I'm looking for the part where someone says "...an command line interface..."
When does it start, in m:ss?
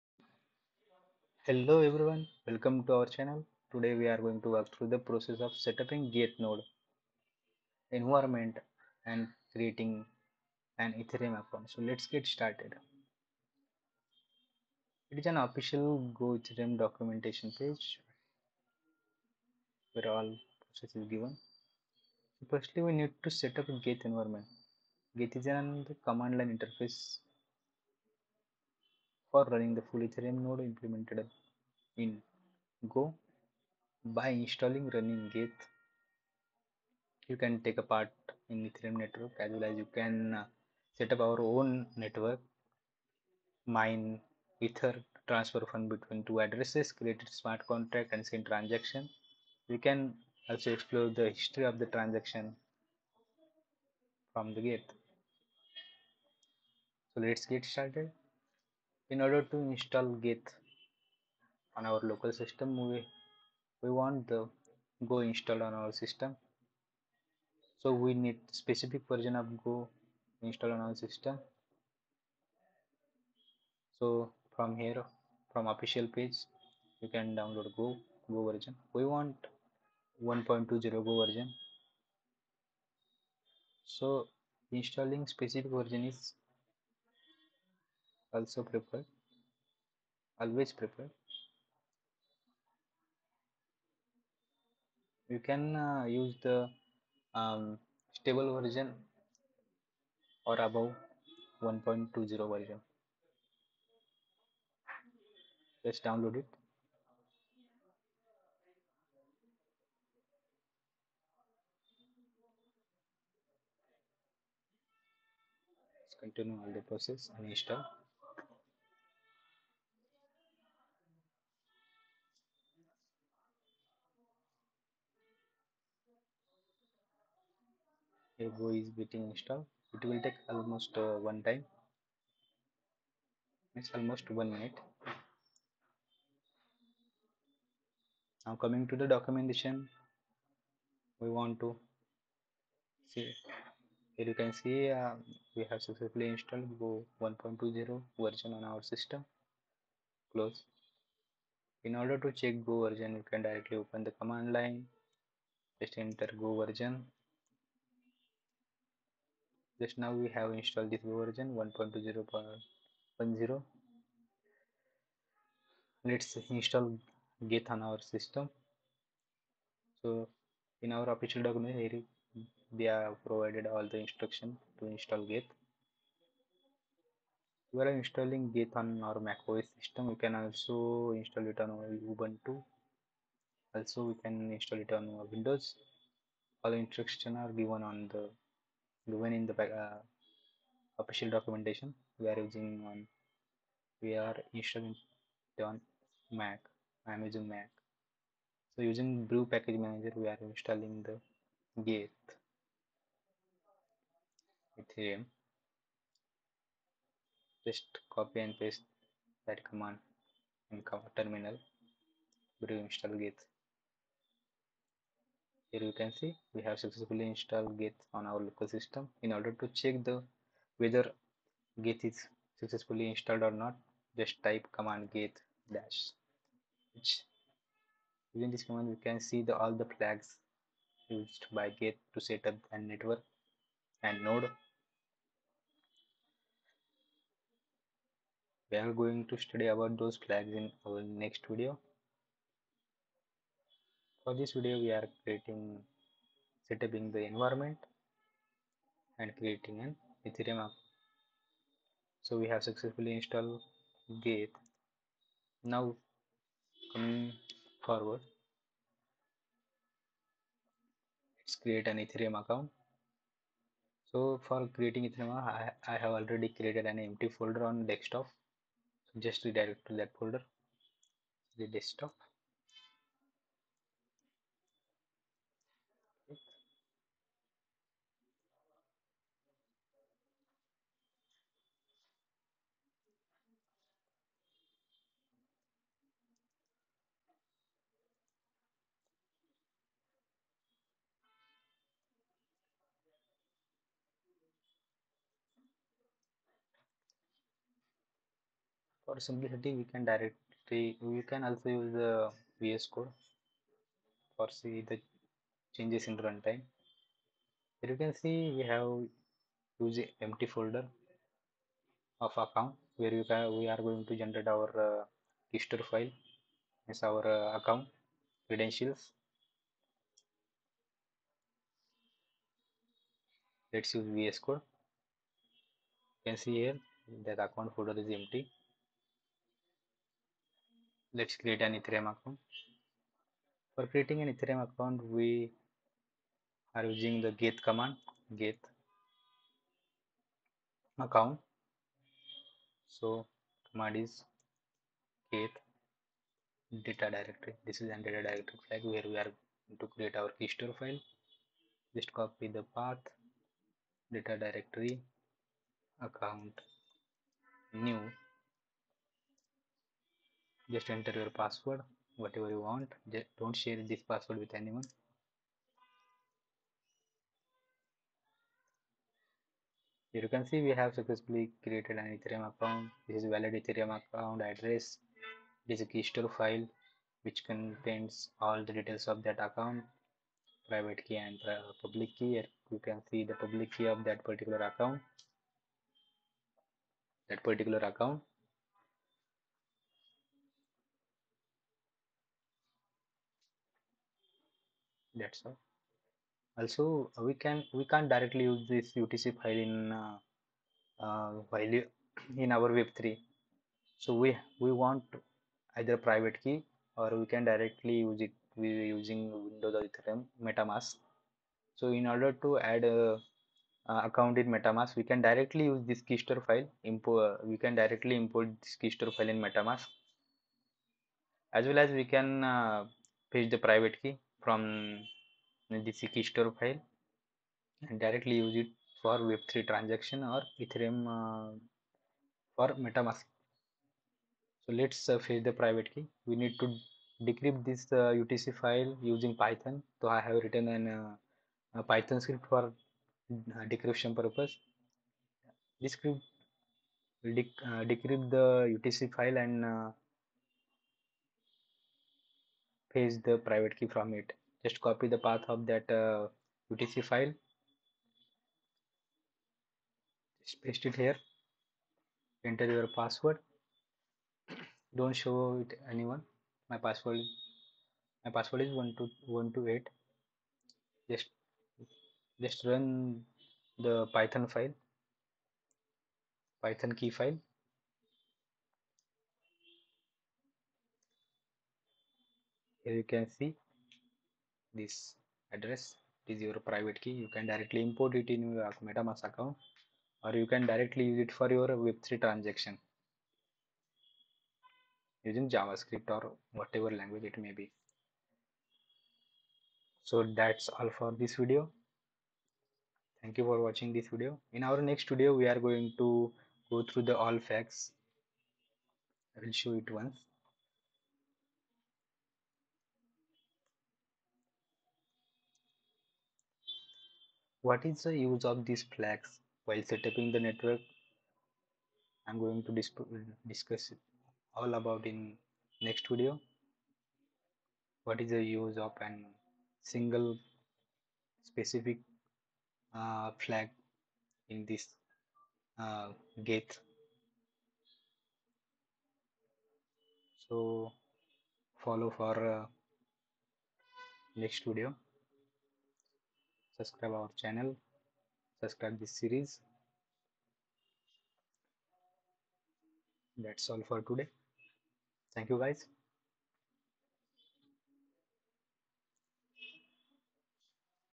0:25.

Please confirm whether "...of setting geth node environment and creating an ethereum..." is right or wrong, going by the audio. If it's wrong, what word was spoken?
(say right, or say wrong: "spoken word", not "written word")
right.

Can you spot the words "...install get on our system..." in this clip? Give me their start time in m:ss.
2:46.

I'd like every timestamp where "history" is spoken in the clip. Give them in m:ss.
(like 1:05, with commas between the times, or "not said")
0:51, 5:15.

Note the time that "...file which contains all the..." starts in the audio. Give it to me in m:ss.
6:16.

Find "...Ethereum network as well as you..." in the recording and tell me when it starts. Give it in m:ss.
0:38.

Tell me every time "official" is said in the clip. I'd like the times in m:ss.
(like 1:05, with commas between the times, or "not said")
0:15, 1:15, 2:51, 3:11.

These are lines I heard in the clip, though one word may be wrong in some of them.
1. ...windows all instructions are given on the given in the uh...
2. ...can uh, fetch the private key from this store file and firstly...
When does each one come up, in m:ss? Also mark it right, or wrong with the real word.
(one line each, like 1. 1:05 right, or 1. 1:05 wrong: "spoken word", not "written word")
1. 3:05 right
2. 7:02 wrong: "directly", not "firstly".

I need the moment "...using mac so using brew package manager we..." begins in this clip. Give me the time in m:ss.
3:17.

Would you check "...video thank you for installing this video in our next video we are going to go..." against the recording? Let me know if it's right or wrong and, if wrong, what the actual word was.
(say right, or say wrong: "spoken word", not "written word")
wrong: "watching", not "installing".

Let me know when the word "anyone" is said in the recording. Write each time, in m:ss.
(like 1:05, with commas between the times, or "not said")
6:04, 7:45.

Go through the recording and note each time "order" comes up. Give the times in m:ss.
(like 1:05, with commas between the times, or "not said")
0:59, 2:31, 3:39, 6:52.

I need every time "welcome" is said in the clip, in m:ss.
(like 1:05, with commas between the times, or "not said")
0:02.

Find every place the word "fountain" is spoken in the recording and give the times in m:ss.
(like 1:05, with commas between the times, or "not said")
not said.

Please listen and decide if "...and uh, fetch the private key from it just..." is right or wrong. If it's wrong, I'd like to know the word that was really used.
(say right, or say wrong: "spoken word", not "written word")
right.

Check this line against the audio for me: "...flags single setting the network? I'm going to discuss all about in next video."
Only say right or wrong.
wrong.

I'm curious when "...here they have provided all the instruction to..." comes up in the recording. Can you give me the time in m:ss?
2:51.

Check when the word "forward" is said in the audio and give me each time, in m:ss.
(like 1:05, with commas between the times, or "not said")
4:17.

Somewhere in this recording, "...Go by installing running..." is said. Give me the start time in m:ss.
0:32.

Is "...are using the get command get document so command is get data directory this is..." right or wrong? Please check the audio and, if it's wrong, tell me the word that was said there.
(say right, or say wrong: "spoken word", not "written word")
wrong: "account", not "document".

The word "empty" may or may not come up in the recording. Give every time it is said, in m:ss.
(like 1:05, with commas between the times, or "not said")
4:27, 5:10, 5:28.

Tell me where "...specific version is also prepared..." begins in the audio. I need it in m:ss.
1:25.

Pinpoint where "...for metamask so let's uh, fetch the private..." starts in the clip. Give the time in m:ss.
7:12.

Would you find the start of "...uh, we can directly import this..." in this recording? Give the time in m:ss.
6:57.